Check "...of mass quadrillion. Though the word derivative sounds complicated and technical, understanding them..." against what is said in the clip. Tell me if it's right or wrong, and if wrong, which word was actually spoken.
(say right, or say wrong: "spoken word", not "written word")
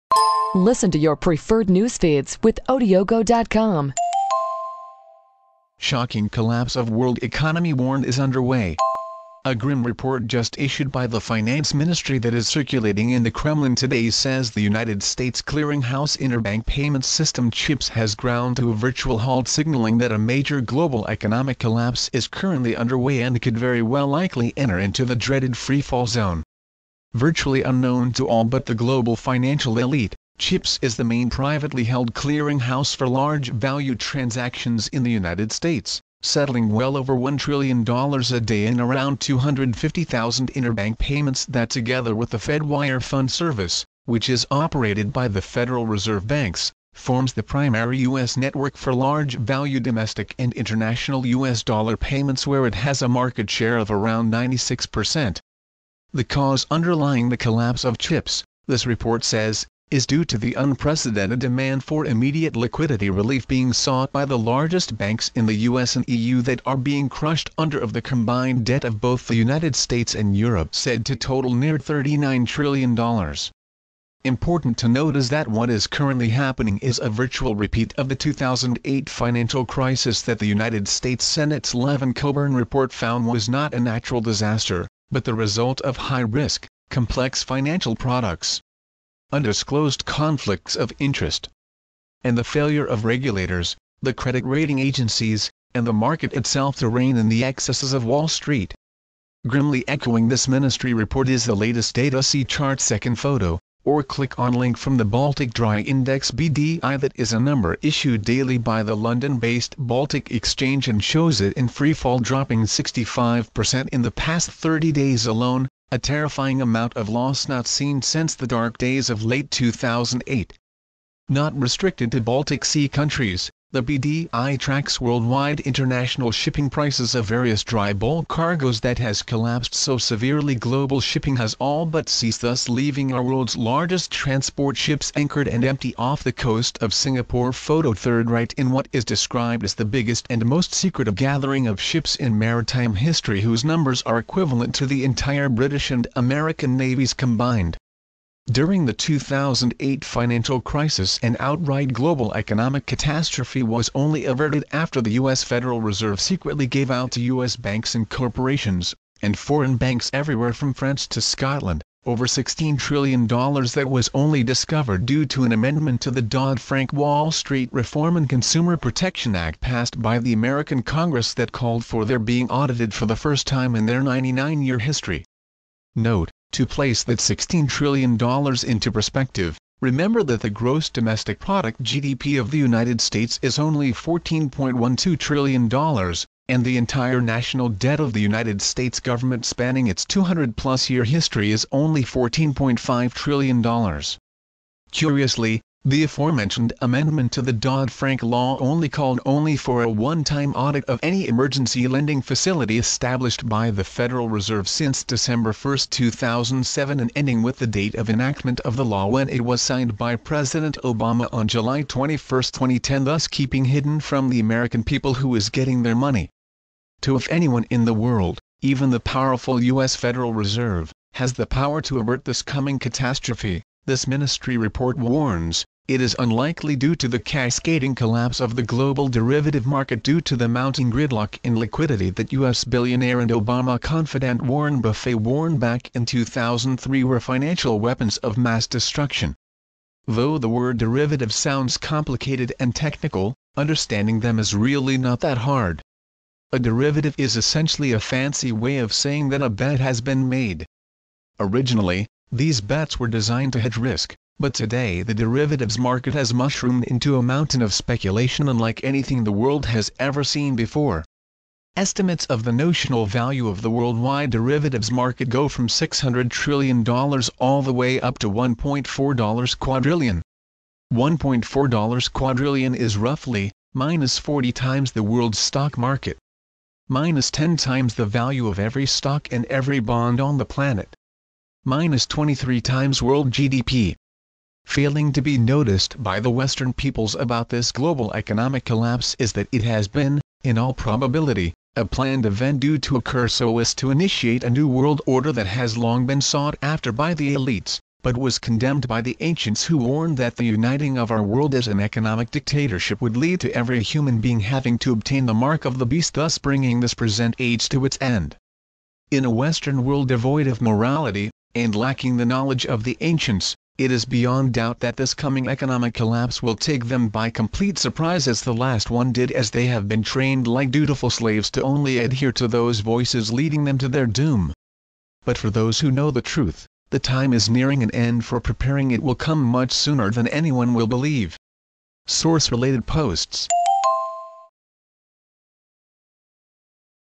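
wrong: "destruction", not "quadrillion".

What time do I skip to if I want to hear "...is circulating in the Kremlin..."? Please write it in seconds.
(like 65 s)
12 s.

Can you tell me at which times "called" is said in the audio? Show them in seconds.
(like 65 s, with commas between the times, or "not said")
171 s, 198 s.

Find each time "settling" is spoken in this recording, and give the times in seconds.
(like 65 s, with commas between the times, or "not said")
36 s.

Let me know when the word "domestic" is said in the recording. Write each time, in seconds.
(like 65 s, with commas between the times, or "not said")
49 s, 180 s.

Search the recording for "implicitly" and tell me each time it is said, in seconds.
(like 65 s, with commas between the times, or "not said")
not said.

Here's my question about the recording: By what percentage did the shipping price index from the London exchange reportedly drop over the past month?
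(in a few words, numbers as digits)
65%.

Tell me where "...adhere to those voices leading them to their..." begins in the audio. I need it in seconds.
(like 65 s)
321 s.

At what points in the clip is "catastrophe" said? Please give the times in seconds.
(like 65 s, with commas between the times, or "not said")
152 s, 222 s.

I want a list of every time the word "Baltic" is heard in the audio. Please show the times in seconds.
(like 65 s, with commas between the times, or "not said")
105 s, 109 s, 122 s.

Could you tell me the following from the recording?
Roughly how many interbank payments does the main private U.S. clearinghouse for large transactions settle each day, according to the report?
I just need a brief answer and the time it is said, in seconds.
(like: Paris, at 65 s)
250,000, at 39 s.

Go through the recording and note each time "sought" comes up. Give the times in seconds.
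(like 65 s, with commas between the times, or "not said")
63 s, 296 s.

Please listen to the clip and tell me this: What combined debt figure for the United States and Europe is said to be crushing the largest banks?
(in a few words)
$39 trillion.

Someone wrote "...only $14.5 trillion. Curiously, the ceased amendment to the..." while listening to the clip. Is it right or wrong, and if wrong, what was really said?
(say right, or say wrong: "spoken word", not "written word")
wrong: "aforementioned", not "ceased".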